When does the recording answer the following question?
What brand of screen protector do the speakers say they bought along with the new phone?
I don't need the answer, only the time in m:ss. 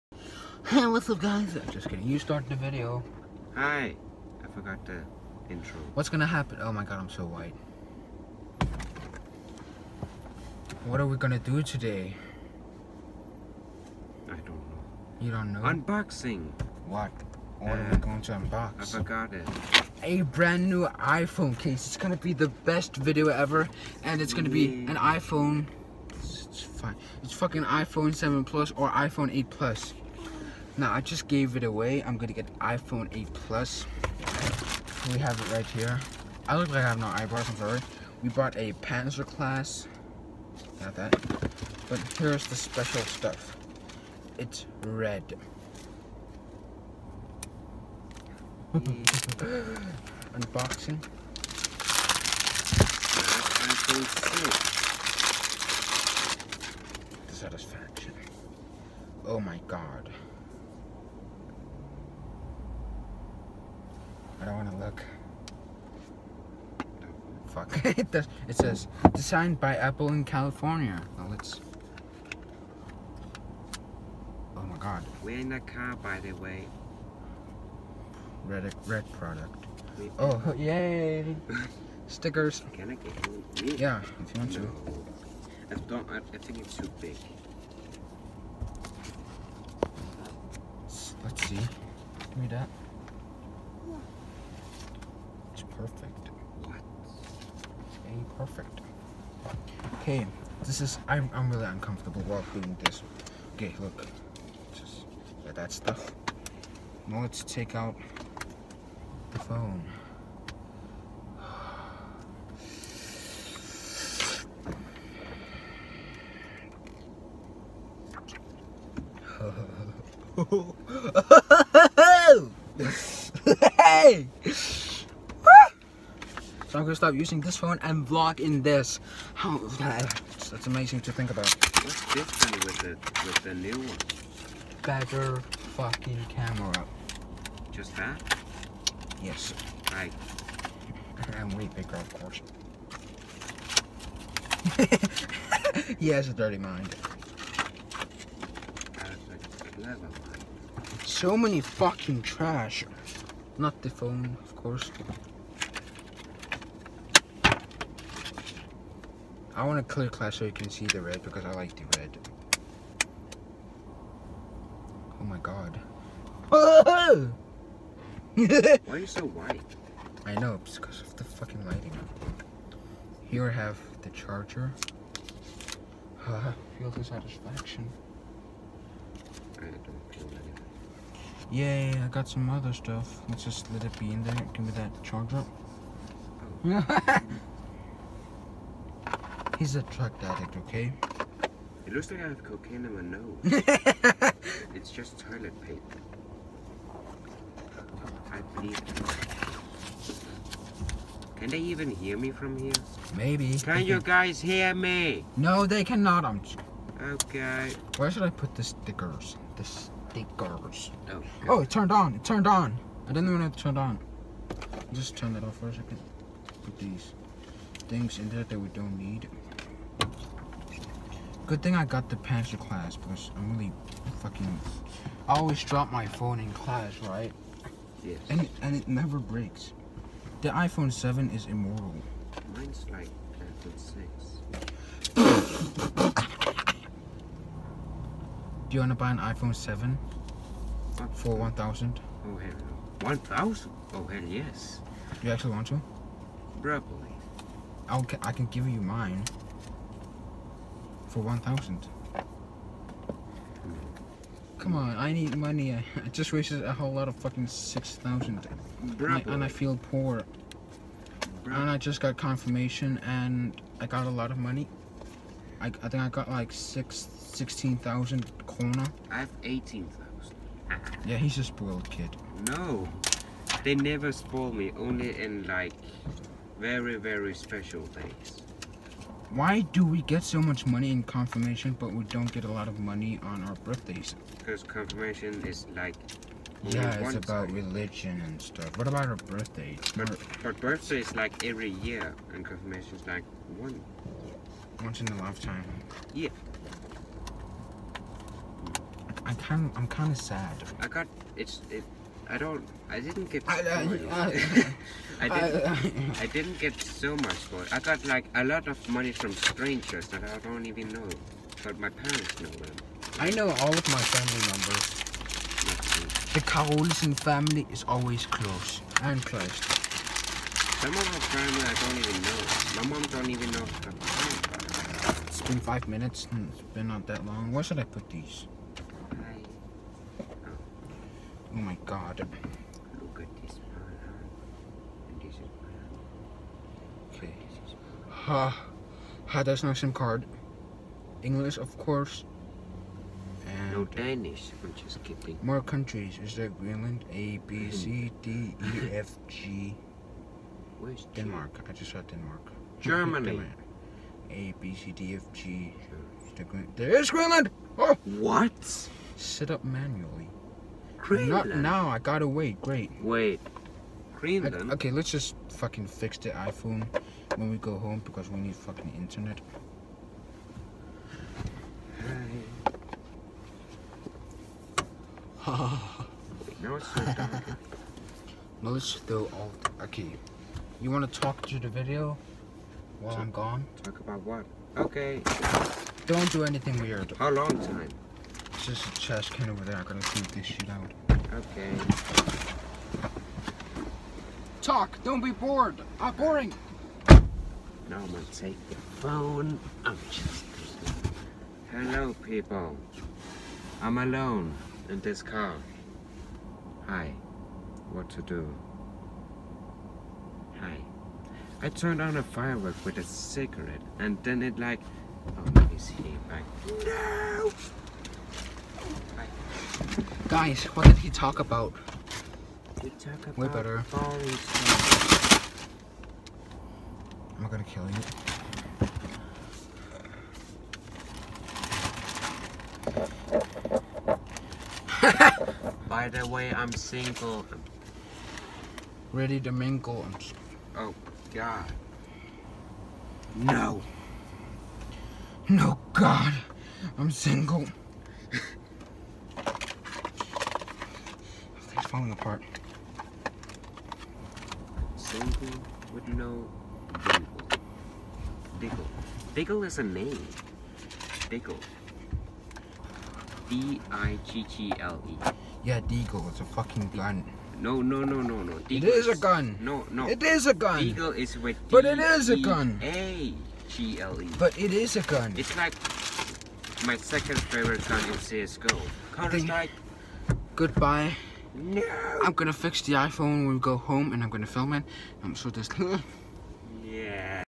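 0:38.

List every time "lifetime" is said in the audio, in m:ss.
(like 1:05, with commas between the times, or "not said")
4:55.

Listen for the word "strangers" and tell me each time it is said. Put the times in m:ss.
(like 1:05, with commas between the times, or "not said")
5:09.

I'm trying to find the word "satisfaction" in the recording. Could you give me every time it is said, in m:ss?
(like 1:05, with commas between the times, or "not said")
0:57, 2:57.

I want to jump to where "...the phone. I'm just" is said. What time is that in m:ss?
6:38.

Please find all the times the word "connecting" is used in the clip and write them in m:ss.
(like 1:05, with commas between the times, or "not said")
not said.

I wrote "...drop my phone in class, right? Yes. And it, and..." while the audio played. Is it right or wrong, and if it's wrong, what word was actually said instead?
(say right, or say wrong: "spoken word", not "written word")
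right.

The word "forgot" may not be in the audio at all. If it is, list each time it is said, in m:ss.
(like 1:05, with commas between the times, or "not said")
0:04, 0:18.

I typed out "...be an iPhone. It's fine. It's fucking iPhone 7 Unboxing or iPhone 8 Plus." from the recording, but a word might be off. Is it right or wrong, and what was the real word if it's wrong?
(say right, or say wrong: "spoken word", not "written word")
wrong: "Plus", not "Unboxing".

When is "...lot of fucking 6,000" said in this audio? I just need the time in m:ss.
4:16.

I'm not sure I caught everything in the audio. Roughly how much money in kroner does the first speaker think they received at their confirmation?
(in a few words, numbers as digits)
16,000 kroner.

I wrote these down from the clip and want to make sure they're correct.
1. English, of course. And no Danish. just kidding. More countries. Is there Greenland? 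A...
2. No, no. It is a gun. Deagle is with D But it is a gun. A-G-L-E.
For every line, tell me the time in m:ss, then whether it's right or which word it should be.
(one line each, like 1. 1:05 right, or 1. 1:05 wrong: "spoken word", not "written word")
1. 5:41 right
2. 7:49 right.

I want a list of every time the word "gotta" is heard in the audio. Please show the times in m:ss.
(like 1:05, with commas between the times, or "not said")
6:01, 6:29.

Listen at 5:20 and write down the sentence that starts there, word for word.
Some of her family I don't even know.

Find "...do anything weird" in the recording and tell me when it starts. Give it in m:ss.
6:26.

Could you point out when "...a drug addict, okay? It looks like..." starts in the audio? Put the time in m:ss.
3:09.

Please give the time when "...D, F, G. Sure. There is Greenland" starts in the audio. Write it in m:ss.
5:54.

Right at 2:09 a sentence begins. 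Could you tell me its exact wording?
How that's, that's amazing to think about.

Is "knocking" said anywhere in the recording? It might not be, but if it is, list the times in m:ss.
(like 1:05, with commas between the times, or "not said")
not said.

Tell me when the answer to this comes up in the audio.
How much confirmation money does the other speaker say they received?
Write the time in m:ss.
4:29.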